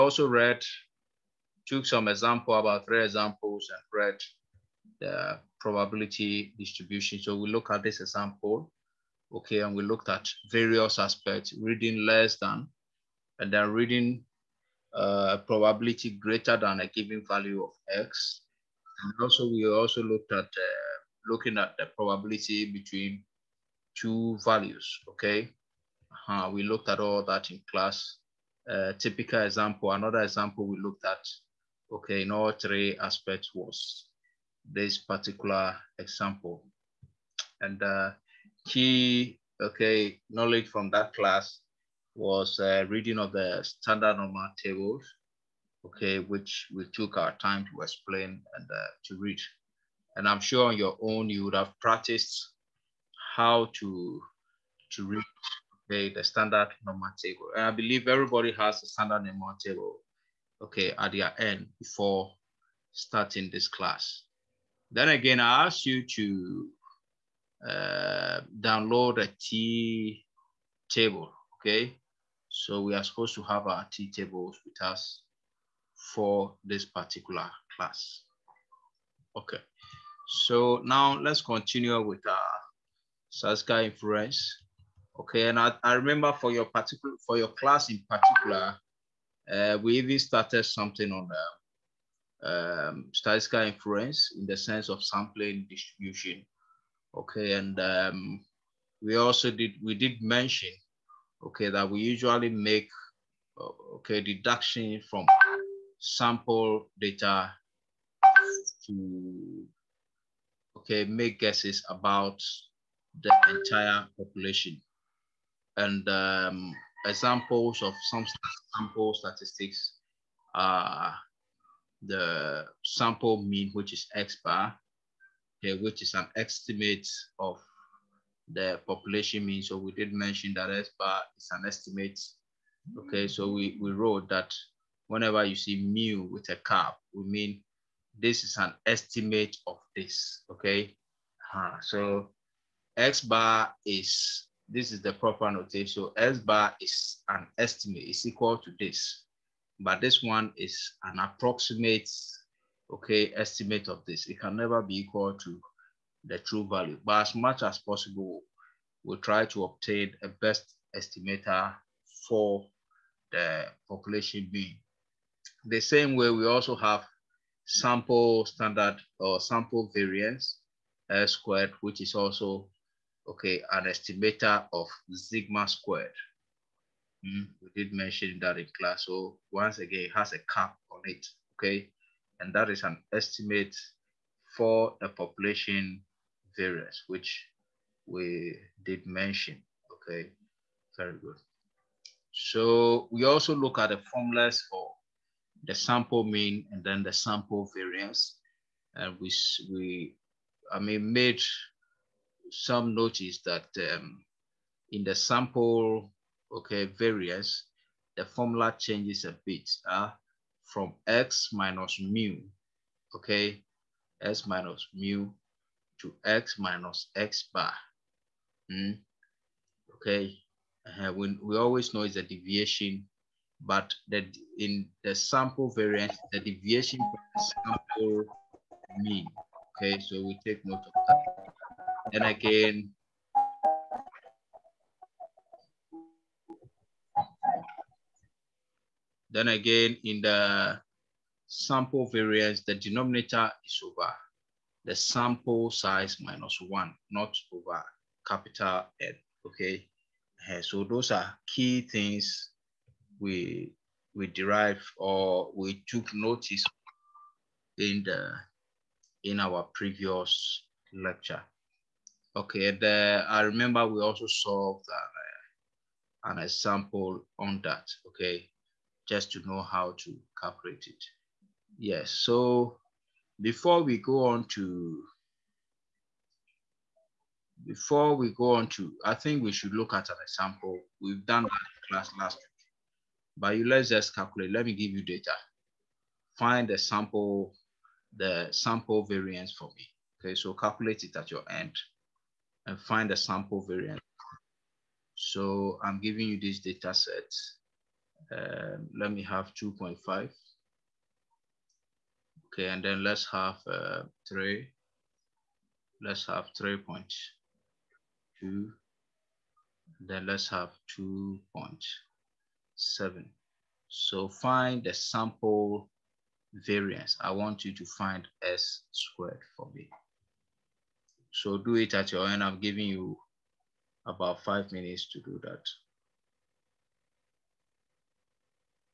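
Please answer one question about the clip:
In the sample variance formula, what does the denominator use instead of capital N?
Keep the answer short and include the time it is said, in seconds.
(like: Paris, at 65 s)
sample size minus one, at 244 s.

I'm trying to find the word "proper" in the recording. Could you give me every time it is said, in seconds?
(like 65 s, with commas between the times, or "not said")
145 s.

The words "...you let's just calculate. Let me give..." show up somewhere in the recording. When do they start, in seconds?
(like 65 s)
283 s.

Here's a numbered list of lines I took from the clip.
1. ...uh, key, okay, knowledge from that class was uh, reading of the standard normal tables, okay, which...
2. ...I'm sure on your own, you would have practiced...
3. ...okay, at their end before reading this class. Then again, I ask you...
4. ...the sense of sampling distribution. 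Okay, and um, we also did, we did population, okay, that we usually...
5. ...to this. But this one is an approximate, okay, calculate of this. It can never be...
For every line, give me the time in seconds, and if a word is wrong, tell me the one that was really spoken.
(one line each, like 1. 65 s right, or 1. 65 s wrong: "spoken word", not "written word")
1. 37 s right
2. 50 s right
3. 60 s wrong: "starting", not "reading"
4. 94 s wrong: "mention", not "population"
5. 148 s wrong: "estimate", not "calculate".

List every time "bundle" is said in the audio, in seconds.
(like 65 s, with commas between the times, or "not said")
not said.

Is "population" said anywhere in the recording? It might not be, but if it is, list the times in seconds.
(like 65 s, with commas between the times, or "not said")
114 s, 128 s, 163 s, 185 s.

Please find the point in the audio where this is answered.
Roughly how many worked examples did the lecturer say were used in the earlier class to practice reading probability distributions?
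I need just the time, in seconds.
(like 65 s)
2 s.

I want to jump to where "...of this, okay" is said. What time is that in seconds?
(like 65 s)
139 s.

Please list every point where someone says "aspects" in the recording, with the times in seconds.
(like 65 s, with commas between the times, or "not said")
10 s, 32 s.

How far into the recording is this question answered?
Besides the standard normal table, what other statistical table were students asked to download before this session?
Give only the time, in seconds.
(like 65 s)
69 s.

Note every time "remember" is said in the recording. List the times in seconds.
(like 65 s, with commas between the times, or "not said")
85 s, 263 s.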